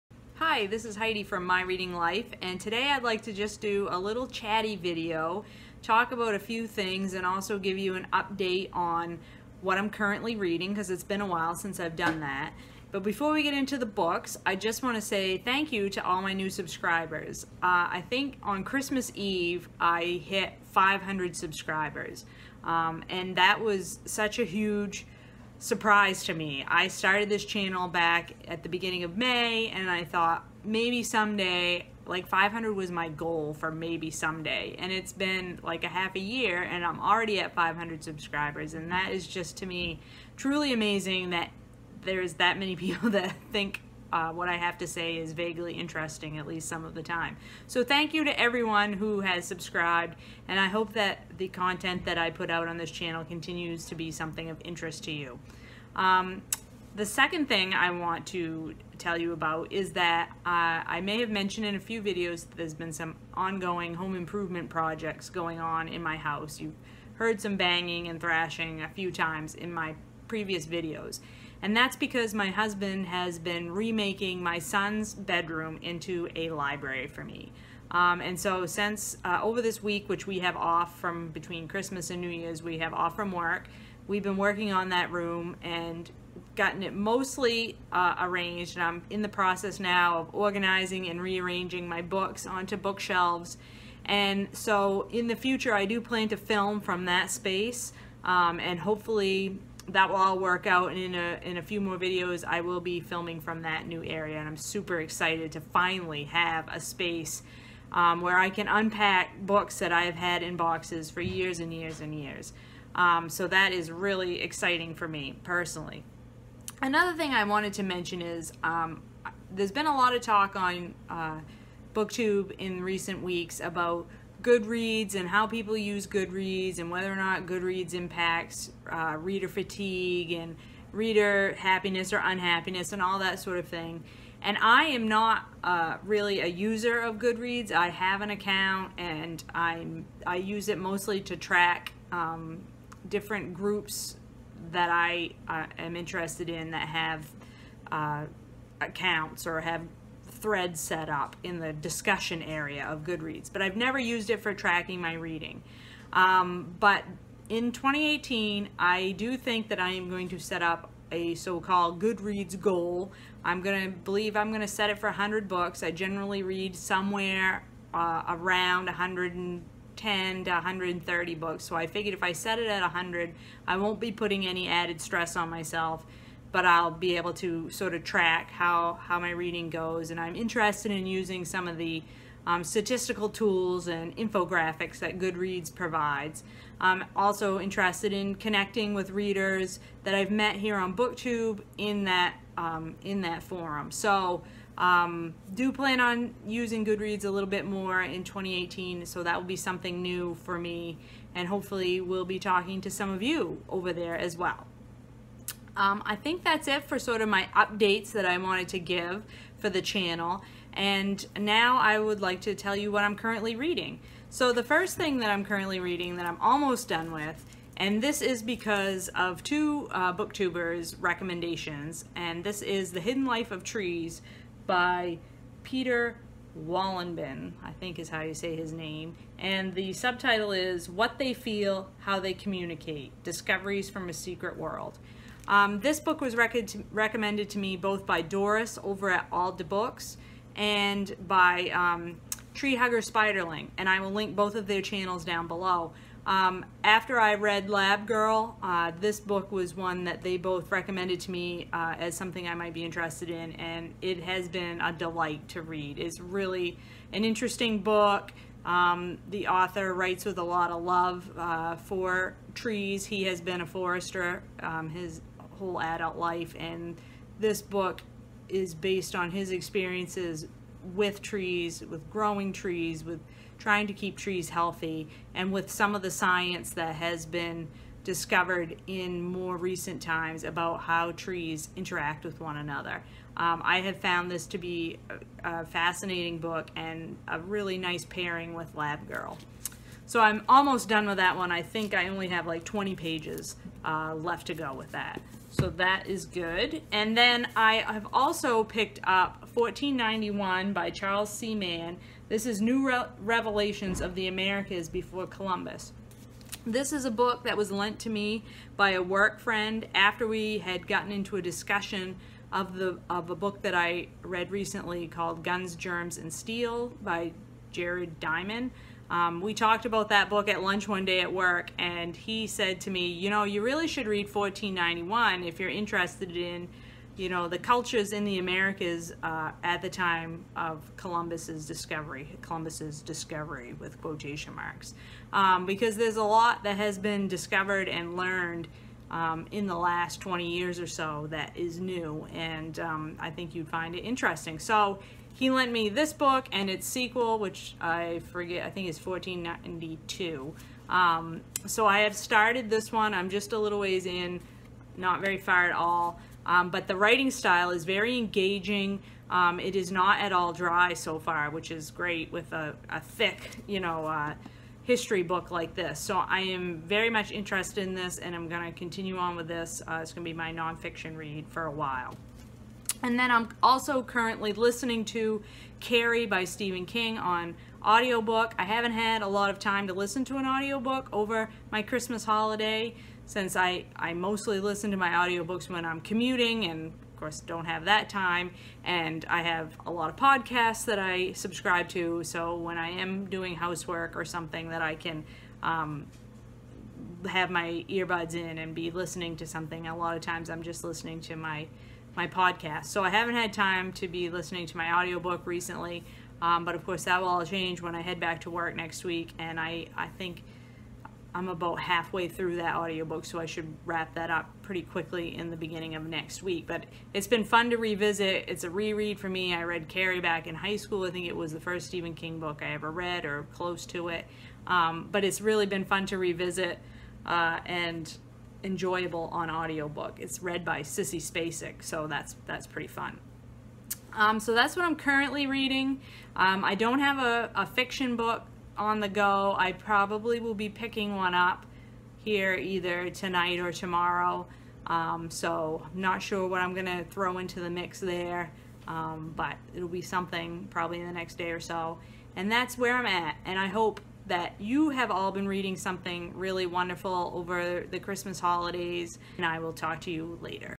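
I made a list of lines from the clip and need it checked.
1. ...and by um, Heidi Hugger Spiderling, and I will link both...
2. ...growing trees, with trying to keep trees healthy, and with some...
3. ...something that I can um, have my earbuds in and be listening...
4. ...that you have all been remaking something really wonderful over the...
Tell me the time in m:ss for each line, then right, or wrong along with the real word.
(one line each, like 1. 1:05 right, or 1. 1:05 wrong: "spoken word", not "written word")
1. 4:00 wrong: "Tree", not "Heidi"
2. 4:32 right
3. 6:34 right
4. 7:34 wrong: "reading", not "remaking".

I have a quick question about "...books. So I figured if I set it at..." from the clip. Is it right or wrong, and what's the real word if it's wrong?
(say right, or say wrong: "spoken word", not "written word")
right.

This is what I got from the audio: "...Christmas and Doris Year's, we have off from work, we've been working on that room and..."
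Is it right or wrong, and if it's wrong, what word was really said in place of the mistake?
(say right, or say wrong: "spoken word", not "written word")
wrong: "New", not "Doris".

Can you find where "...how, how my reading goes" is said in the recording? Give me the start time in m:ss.
2:58.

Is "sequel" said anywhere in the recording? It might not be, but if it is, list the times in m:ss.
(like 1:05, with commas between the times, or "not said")
5:46.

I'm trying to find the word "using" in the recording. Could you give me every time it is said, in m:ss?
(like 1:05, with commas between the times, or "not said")
3:01, 3:16.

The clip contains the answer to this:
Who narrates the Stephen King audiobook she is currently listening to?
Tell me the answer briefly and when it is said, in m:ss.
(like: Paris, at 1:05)
Sissy Spacek, at 7:10.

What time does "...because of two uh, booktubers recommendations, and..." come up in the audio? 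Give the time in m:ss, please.
3:38.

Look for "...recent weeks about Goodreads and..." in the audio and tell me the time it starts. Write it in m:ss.
2:02.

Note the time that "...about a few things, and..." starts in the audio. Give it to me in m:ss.
0:06.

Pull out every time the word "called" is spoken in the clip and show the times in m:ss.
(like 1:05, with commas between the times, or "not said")
2:41, 5:15.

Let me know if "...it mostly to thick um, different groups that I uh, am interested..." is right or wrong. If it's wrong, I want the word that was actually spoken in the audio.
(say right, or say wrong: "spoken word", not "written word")
wrong: "track", not "thick".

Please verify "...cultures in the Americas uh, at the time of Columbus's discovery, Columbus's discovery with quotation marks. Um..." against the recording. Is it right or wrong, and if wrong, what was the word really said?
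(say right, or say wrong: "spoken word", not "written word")
right.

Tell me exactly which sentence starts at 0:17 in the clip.
Uh, I think on Christmas Eve, I hit 500 subscribers, um, and that was such a huge surprise to me.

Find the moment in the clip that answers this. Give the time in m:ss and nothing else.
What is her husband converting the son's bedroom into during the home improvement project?
1:16.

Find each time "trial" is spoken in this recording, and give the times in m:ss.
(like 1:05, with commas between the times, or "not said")
not said.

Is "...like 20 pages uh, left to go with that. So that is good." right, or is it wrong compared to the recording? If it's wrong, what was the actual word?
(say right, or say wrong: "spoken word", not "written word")
right.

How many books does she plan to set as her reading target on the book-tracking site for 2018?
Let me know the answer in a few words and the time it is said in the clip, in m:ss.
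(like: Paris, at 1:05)
100, at 2:45.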